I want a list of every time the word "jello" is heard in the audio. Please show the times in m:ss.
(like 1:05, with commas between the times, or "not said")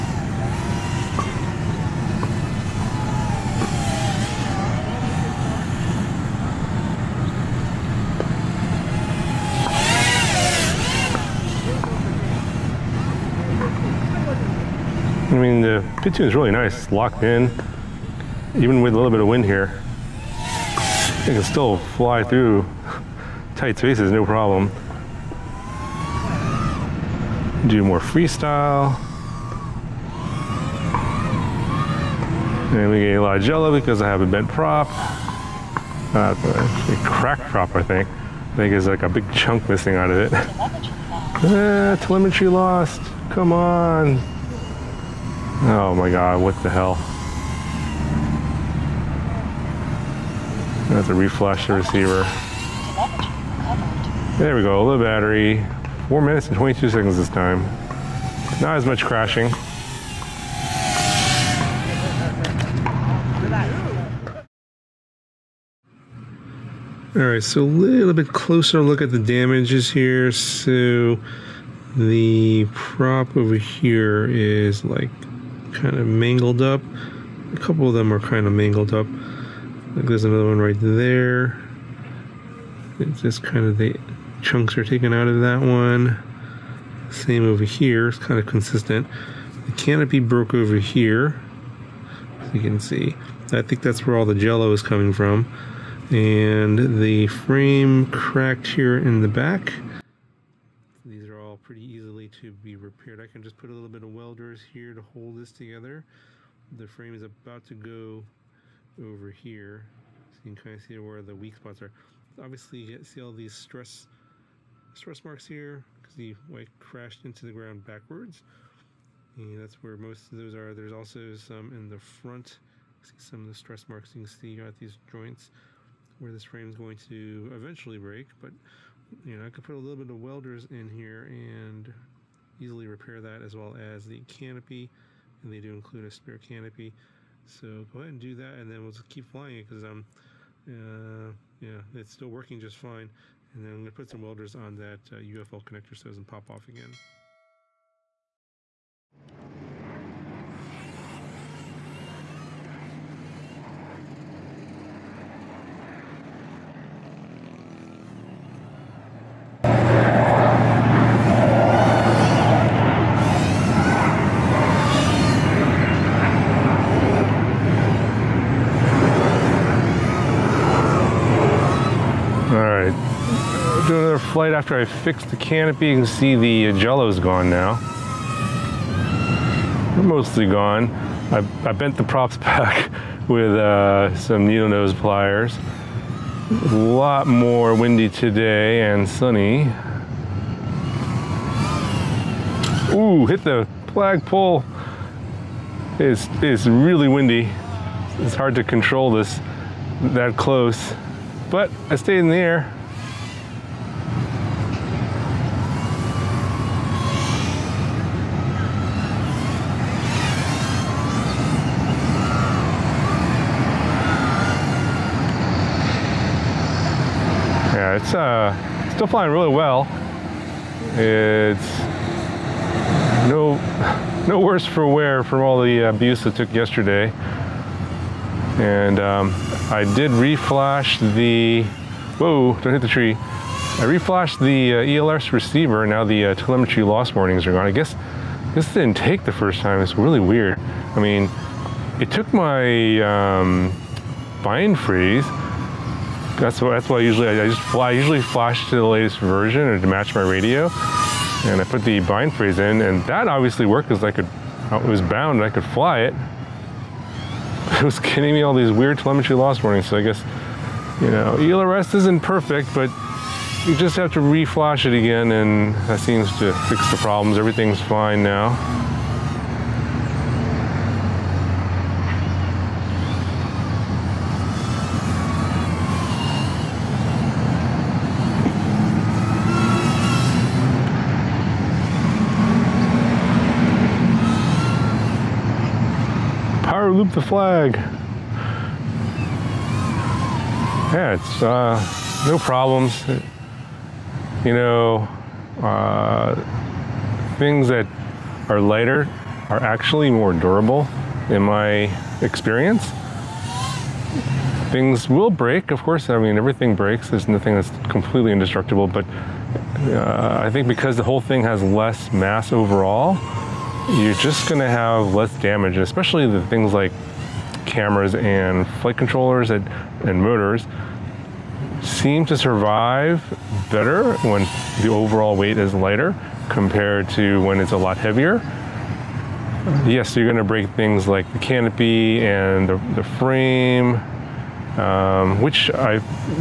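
0:33, 1:34, 2:56.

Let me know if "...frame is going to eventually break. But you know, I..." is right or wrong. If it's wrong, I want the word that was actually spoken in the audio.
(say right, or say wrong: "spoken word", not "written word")
right.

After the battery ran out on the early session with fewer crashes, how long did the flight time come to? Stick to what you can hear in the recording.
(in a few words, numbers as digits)
4 minutes 22 seconds.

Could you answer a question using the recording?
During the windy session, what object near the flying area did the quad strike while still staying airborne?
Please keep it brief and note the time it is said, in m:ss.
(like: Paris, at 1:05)
the flagpole, at 3:13.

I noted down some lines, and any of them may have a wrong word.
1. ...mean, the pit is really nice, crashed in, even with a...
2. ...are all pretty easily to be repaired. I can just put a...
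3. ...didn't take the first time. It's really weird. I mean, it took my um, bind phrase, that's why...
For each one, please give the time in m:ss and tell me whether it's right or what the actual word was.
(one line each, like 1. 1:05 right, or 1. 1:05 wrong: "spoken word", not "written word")
1. 0:15 wrong: "locked", not "crashed"
2. 1:41 right
3. 3:58 right.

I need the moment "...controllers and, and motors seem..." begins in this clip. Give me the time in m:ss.
5:18.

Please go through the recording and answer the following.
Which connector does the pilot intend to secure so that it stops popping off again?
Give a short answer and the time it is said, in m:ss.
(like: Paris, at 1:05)
UFL connector, at 2:25.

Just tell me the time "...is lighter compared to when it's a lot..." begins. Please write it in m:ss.
5:25.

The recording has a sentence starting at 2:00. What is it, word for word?
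There's also some in the front.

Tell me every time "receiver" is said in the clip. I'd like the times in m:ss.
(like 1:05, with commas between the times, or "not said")
0:51, 3:55.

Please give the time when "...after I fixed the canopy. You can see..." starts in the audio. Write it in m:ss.
2:54.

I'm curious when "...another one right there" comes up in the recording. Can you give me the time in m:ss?
1:20.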